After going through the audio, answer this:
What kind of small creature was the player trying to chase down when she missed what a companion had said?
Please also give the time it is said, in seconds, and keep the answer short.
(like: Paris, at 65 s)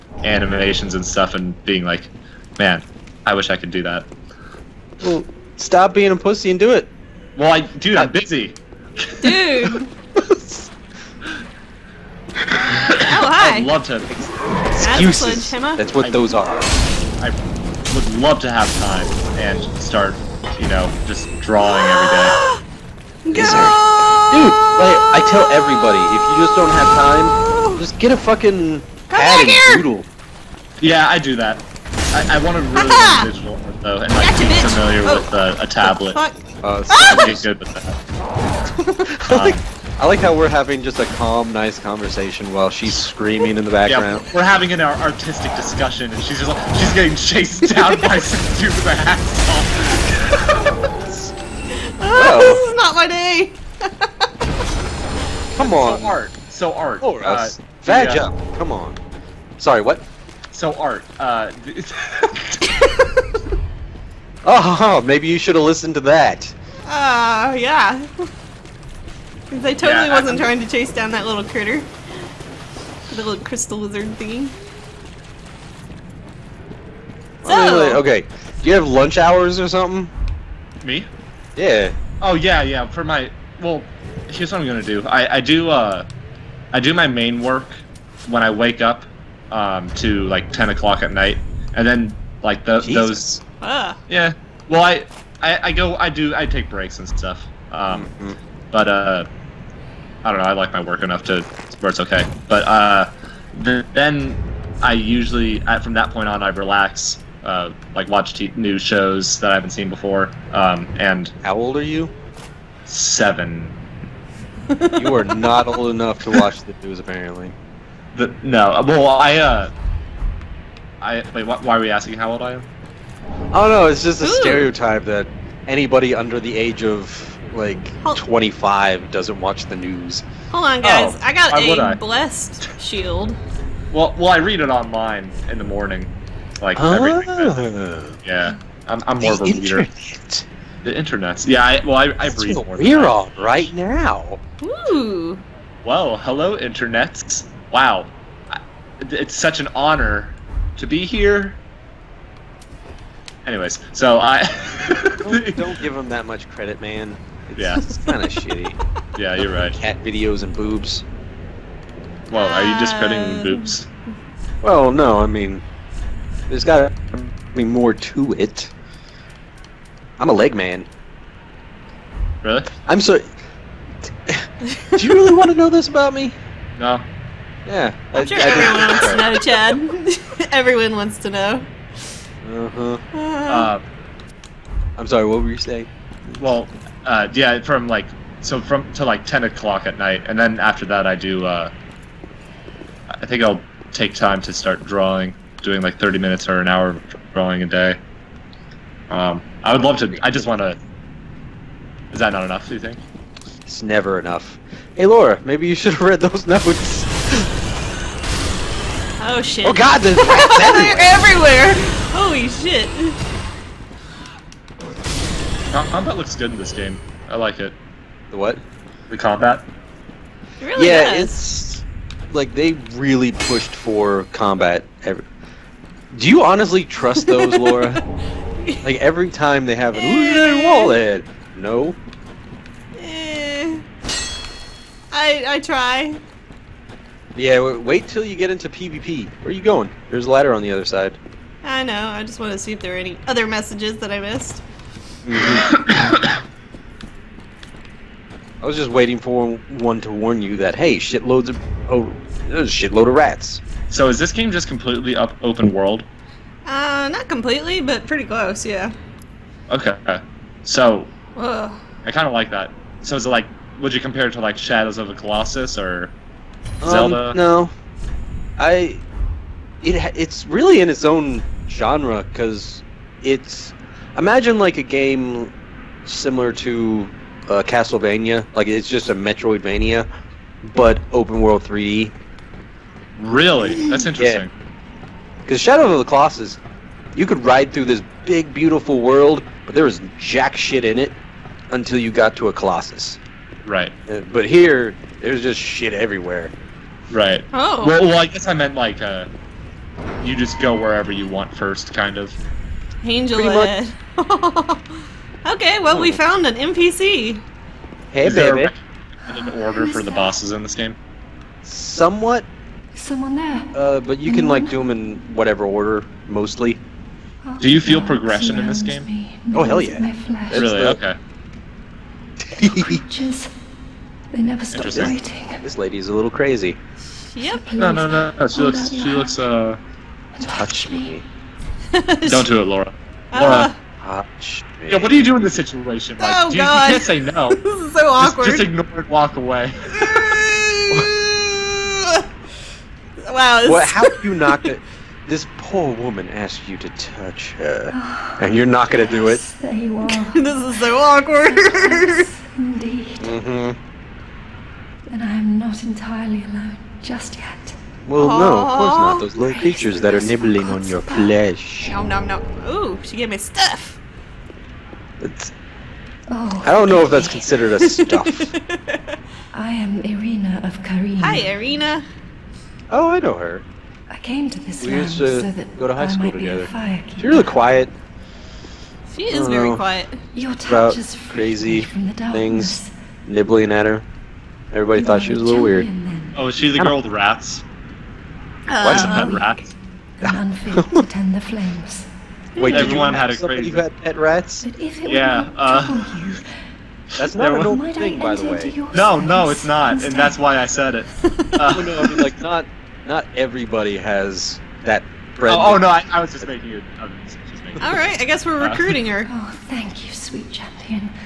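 crystal lizard, at 73 s.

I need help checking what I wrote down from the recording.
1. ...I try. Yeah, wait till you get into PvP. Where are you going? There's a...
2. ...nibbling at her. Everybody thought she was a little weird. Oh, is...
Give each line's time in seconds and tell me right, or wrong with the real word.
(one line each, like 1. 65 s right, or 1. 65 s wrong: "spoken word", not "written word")
1. 235 s right
2. 383 s right.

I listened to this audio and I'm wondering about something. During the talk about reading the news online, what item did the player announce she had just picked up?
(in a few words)
blessed shield.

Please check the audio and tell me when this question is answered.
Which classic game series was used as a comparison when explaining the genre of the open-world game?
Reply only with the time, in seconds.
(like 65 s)
277 s.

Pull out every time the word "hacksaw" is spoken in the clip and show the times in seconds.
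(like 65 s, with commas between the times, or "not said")
48 s.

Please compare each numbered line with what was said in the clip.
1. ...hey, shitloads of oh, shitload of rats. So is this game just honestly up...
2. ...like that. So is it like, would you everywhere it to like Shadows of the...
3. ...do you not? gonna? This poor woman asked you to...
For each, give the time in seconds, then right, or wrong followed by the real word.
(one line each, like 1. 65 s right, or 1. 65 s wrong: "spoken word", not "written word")
1. 250 s wrong: "completely", not "honestly"
2. 262 s wrong: "compare", not "everywhere"
3. 344 s right.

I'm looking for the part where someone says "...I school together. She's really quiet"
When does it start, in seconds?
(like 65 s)
376 s.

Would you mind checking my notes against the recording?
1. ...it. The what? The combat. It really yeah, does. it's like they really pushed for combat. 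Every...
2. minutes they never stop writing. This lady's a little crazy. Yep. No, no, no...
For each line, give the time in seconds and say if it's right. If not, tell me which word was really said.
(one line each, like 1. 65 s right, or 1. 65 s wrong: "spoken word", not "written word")
1. 217 s right
2. 322 s wrong: "creatures", not "minutes".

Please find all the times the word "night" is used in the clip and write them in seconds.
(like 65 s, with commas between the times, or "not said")
91 s, 189 s.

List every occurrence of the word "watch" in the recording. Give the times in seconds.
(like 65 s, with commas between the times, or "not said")
108 s, 116 s, 129 s.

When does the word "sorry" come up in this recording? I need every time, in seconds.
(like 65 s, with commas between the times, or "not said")
59 s, 185 s.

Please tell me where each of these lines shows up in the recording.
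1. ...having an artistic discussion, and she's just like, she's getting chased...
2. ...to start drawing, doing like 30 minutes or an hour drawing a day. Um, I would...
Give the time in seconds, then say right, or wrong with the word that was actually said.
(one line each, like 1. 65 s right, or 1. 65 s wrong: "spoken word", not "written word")
1. 44 s right
2. 194 s right.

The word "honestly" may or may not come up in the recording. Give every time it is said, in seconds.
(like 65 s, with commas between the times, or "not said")
226 s.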